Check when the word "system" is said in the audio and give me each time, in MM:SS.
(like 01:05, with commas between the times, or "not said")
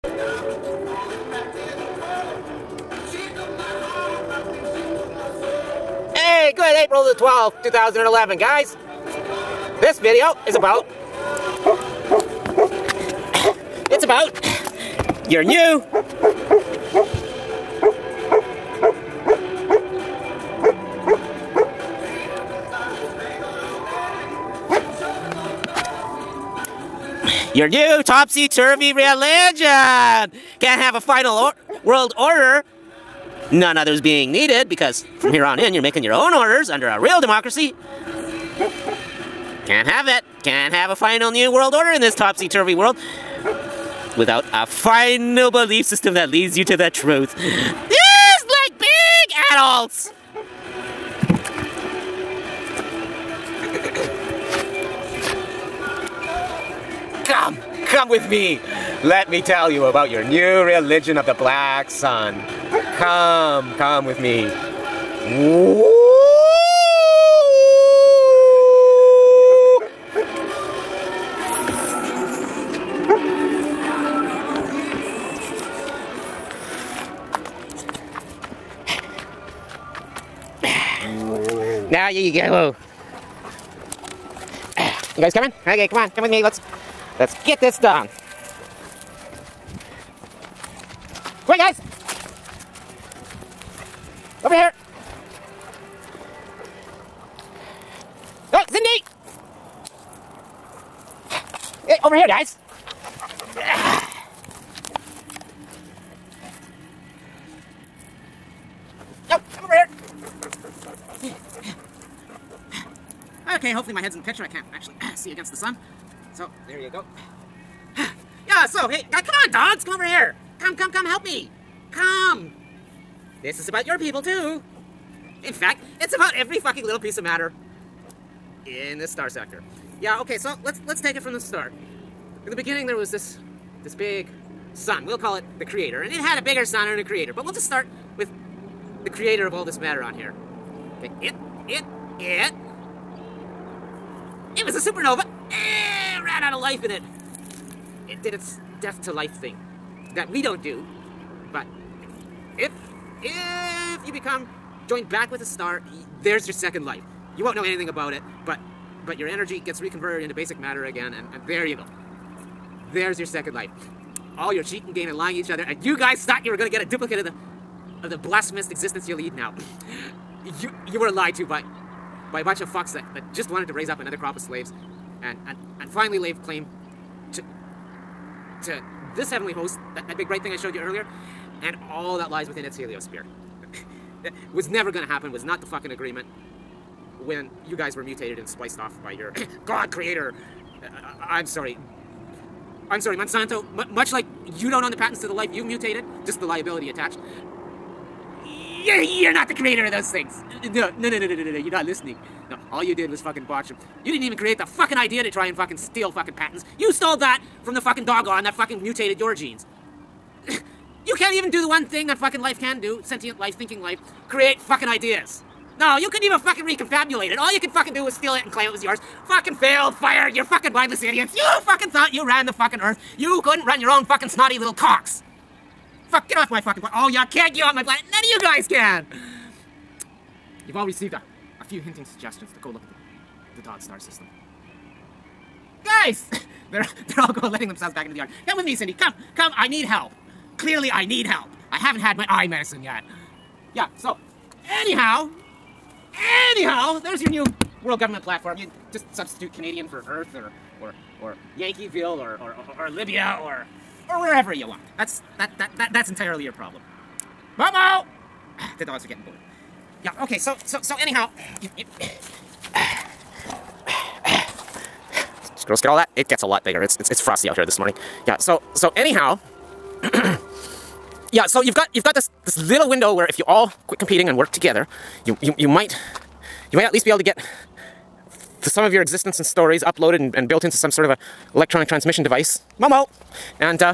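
00:45, 03:53.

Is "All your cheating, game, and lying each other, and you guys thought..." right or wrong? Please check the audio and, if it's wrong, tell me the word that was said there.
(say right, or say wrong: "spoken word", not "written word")
right.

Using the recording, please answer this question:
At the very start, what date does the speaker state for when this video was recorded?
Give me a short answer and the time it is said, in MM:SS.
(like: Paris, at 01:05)
April 12, 2011, at 00:06.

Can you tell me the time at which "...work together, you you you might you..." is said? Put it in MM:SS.
04:34.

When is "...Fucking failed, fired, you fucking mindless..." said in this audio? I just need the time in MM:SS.
03:39.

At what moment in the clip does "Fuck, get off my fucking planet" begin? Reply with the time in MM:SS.
03:46.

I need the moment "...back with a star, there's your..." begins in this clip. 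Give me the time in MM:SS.
02:35.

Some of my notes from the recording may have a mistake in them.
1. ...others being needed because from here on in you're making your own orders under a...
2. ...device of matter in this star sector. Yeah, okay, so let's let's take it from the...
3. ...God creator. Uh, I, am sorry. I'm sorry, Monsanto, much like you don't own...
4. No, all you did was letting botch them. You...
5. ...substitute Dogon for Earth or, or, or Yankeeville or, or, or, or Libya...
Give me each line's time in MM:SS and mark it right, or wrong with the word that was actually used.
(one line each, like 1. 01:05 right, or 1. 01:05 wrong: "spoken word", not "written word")
1. 00:33 right
2. 02:06 wrong: "piece", not "device"
3. 03:09 right
4. 03:22 wrong: "fucking", not "letting"
5. 04:09 wrong: "Canadian", not "Dogon".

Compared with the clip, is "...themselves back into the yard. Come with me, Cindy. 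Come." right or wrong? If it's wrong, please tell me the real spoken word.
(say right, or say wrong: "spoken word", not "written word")
right.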